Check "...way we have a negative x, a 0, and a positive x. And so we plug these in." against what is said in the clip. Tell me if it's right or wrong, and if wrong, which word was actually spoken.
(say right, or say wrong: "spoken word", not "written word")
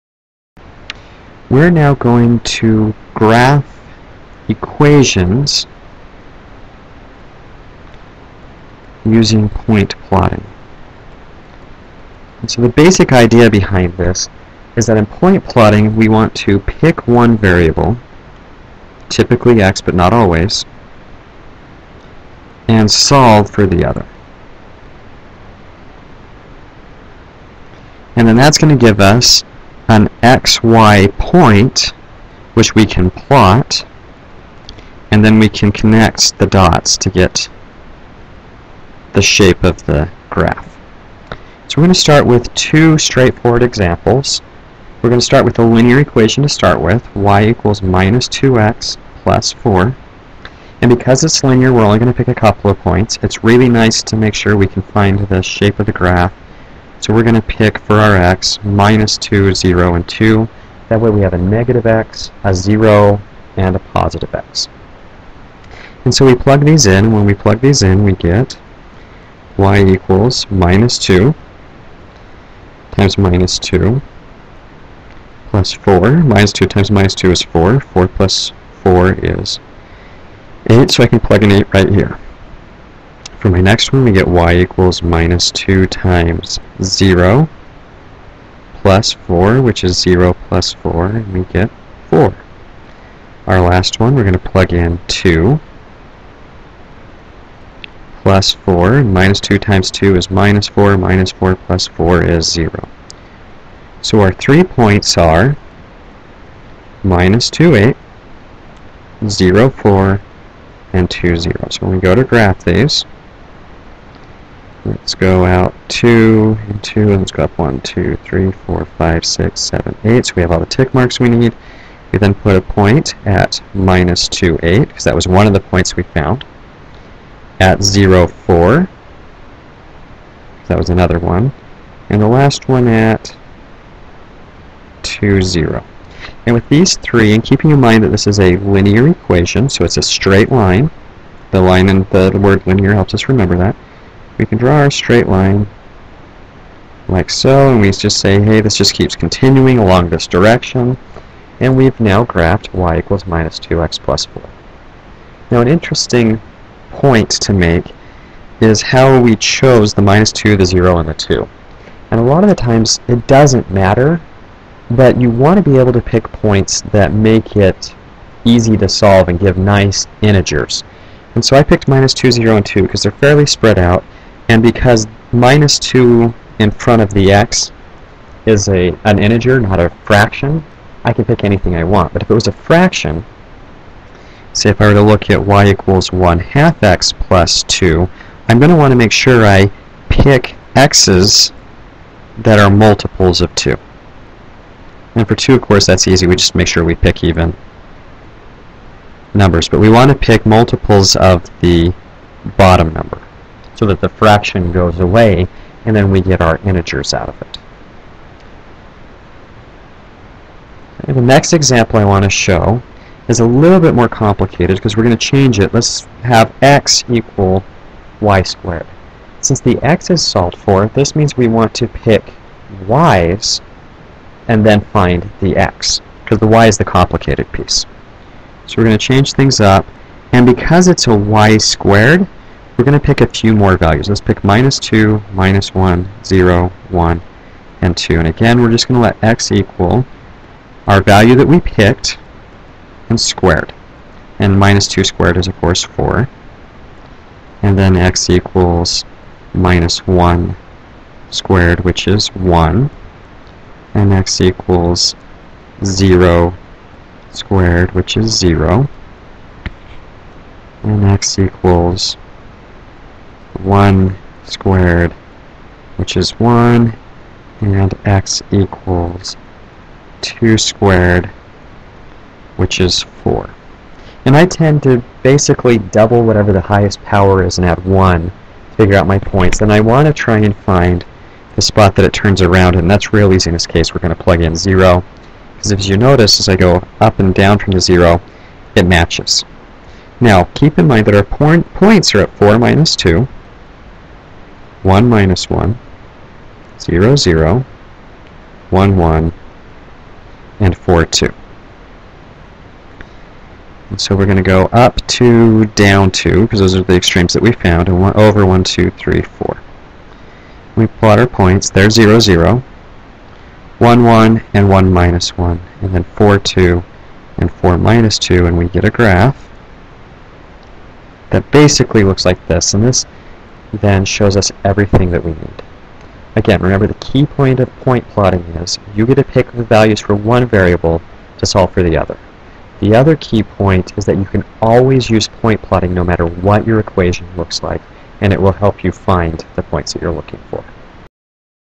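right.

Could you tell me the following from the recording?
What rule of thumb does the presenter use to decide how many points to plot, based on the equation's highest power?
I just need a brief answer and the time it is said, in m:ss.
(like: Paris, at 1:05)
Double it and add 1, at 4:35.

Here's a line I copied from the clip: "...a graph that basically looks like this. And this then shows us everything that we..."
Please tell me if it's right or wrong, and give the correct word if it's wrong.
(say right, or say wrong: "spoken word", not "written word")
right.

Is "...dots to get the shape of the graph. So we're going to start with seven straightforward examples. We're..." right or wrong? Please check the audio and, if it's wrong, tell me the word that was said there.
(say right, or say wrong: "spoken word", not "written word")
wrong: "two", not "seven".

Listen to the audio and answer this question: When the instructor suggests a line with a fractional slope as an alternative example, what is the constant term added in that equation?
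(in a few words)
2.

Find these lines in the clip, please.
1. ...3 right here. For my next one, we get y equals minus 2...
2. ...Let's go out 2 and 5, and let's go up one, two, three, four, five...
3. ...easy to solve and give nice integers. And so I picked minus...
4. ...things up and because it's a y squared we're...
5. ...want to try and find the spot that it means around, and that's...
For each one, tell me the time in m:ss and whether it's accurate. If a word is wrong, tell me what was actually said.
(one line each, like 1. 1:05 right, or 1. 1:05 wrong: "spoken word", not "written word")
1. 1:21 wrong: "8", not "3"
2. 1:54 wrong: "2", not "5"
3. 2:48 right
4. 3:49 right
5. 4:39 wrong: "turns", not "means".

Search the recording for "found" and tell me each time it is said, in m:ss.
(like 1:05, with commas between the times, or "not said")
2:06, 5:07.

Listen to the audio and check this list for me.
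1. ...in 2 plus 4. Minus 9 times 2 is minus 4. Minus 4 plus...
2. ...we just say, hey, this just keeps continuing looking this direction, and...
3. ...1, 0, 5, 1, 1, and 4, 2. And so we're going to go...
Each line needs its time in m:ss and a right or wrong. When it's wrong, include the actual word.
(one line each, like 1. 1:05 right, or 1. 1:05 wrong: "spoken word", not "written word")
1. 1:34 wrong: "2", not "9"
2. 2:27 wrong: "along", not "looking"
3. 4:55 wrong: "0", not "5".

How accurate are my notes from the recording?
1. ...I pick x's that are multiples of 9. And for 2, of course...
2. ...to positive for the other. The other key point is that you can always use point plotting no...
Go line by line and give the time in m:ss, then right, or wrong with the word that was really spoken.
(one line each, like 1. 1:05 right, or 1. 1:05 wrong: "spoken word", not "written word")
1. 3:09 wrong: "2", not "9"
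2. 5:31 wrong: "solve", not "positive".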